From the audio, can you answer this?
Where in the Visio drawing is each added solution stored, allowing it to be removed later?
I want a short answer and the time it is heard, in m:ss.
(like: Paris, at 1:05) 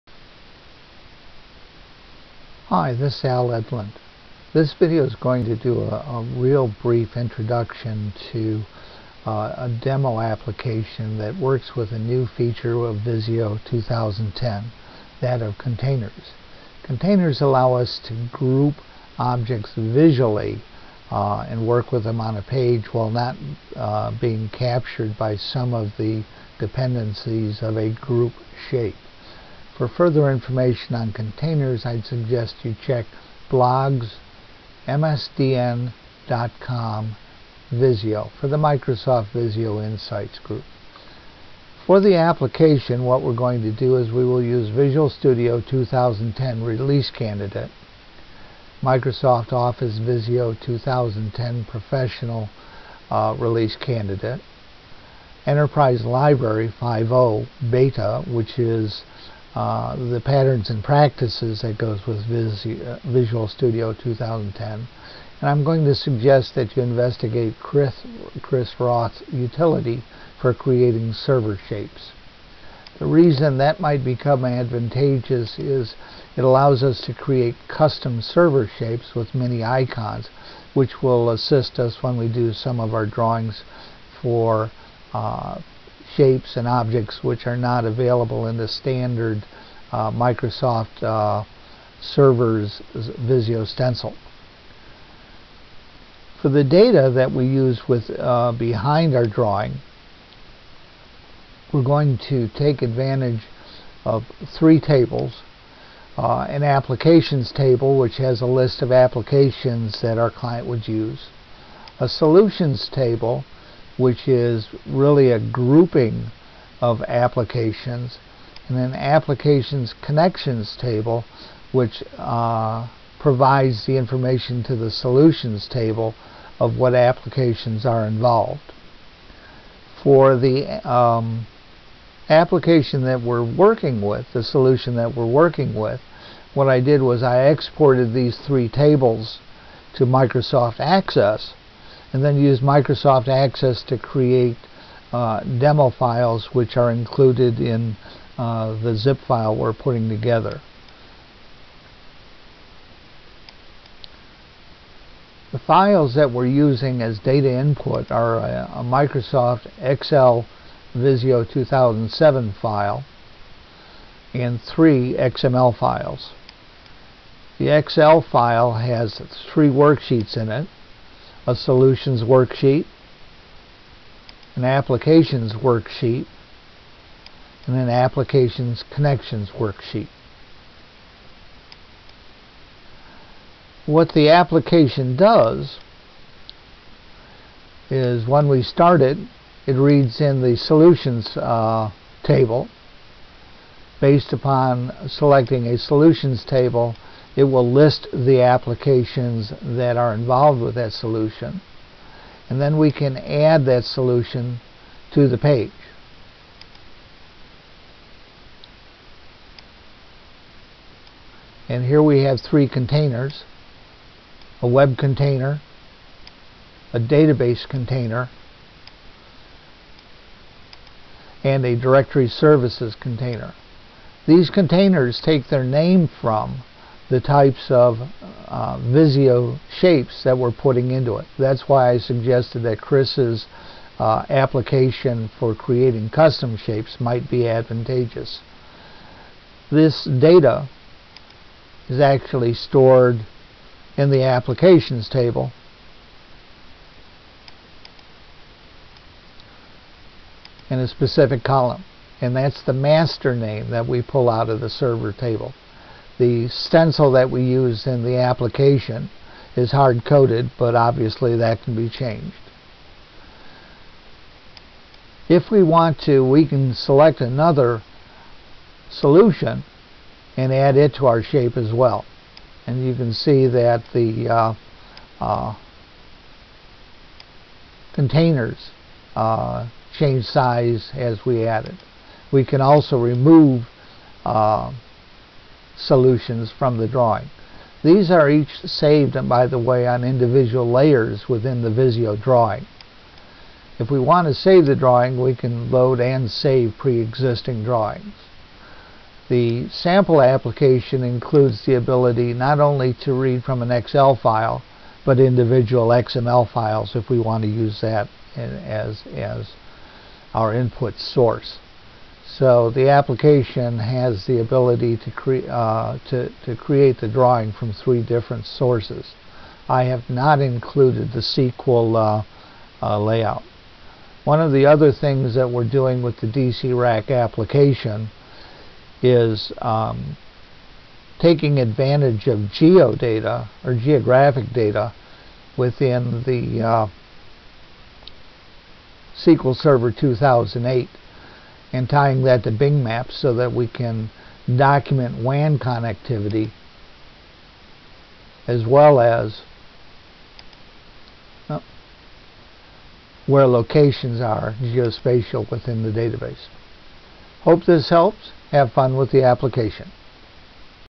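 individual layers, at 4:50.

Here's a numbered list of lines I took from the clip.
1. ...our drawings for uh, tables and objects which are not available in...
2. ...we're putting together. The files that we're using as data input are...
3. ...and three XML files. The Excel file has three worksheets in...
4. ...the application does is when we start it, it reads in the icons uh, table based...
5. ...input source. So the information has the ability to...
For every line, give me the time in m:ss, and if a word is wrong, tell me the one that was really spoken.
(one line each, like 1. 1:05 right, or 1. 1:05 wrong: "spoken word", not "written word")
1. 1:22 wrong: "shapes", not "tables"
2. 2:29 right
3. 2:44 right
4. 3:04 wrong: "solutions", not "icons"
5. 5:10 wrong: "application", not "information".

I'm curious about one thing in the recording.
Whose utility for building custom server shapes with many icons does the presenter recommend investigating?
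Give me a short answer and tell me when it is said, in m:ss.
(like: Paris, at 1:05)
Chris Roth, at 1:08.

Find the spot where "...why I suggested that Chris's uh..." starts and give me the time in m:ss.
3:51.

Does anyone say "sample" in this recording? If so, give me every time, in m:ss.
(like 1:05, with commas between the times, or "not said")
4:59.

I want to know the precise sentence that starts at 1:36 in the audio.
For the data that we use with uh, behind our drawing, we're going to take advantage of three tables.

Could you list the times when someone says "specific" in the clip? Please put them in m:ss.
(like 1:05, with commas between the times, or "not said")
4:10.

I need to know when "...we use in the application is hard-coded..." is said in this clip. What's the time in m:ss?
4:17.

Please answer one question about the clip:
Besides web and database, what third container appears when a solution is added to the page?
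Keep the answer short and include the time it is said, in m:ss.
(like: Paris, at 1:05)
directory services, at 3:41.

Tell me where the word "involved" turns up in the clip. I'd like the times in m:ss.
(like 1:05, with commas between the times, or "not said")
2:08, 3:20.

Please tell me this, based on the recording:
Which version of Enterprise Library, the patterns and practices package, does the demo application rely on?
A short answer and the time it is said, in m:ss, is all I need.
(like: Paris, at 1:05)
5.0 Beta, at 0:55.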